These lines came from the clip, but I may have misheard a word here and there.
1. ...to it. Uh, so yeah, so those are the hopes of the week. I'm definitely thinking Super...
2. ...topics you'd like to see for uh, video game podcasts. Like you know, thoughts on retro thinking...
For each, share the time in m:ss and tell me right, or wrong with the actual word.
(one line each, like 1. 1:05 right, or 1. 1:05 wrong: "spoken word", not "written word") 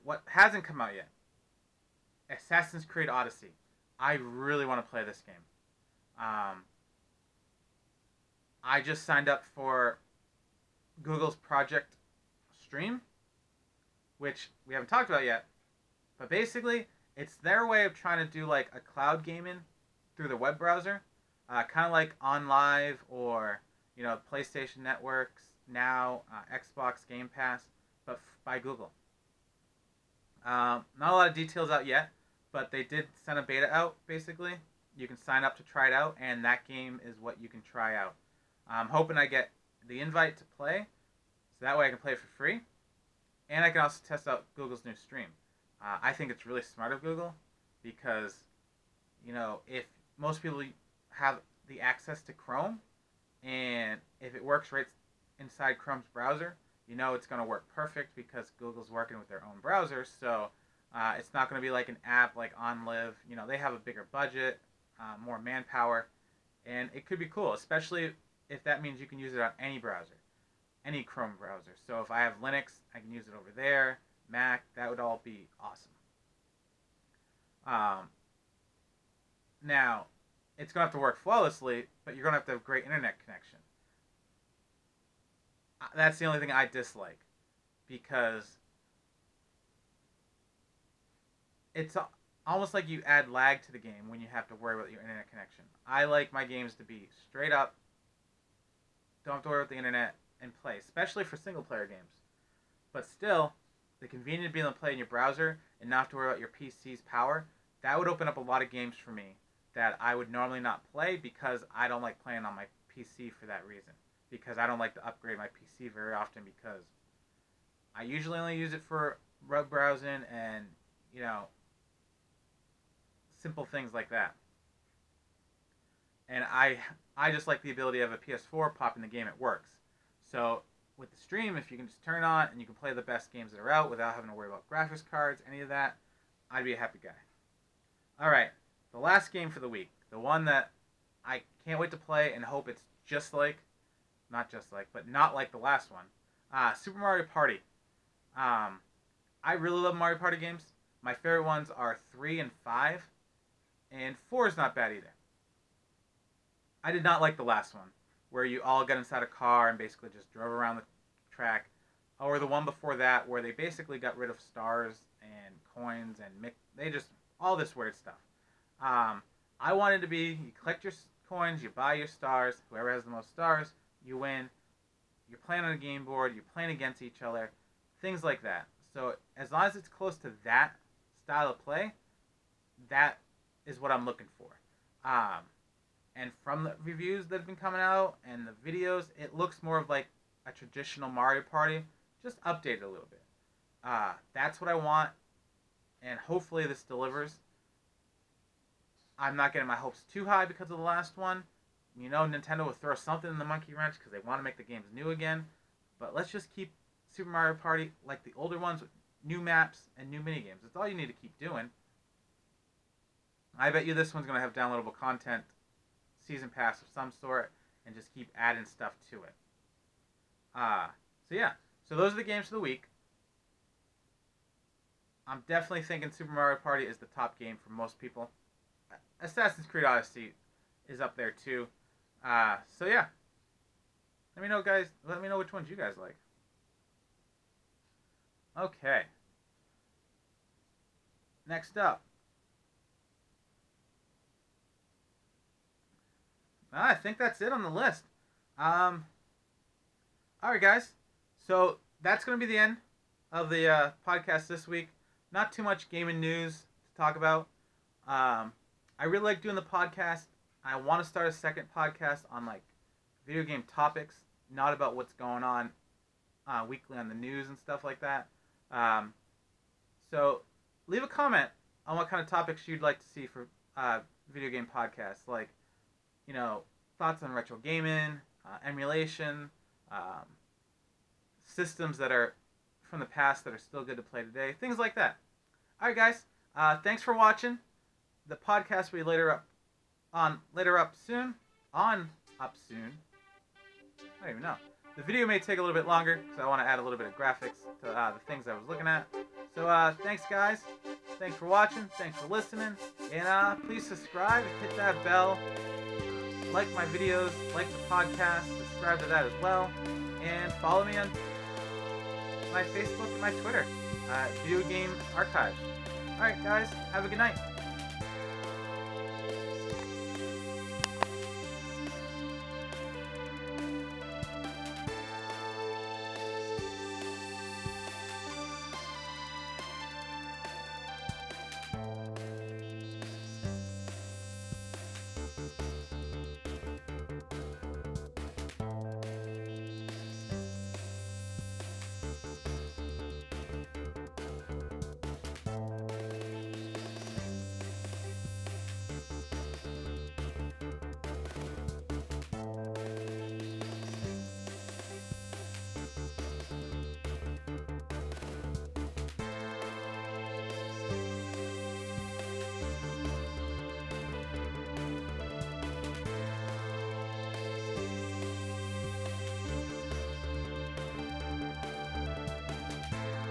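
1. 3:39 wrong: "games", not "hopes"
2. 4:32 wrong: "gaming", not "thinking".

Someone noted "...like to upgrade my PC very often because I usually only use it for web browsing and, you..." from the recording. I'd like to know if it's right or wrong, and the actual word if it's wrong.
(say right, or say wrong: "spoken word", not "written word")
right.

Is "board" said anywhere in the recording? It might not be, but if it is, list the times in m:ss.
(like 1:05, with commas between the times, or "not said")
2:56.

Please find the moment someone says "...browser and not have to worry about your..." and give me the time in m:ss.
1:45.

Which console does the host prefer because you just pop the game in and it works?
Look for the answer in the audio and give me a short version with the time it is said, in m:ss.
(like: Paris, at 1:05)
PS4, at 2:08.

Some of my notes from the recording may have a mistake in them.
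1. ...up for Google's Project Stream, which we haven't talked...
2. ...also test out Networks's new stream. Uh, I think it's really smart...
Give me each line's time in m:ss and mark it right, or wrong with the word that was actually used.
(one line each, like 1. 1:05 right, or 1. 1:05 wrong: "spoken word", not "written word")
1. 0:09 right
2. 0:43 wrong: "Google", not "Networks".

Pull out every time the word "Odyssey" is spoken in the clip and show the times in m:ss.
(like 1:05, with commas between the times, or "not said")
0:03, 3:49.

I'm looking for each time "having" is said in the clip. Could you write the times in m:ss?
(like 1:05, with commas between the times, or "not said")
2:14.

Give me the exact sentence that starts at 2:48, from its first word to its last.
Um, I wanted to be you collect your coins, you buy your stars, whoever has the most stars, you win.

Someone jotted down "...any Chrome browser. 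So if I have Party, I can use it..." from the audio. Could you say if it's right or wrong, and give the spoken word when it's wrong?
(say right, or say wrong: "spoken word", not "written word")
wrong: "Linux", not "Party".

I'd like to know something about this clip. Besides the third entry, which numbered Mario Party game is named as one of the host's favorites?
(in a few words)
5.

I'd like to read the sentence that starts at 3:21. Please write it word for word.
You know, Nintendo will throw something in the monkey wrench because they want to make the games new again.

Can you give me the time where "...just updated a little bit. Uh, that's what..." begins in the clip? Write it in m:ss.
3:12.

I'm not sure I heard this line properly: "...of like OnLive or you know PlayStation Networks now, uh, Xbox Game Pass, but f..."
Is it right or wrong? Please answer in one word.
right.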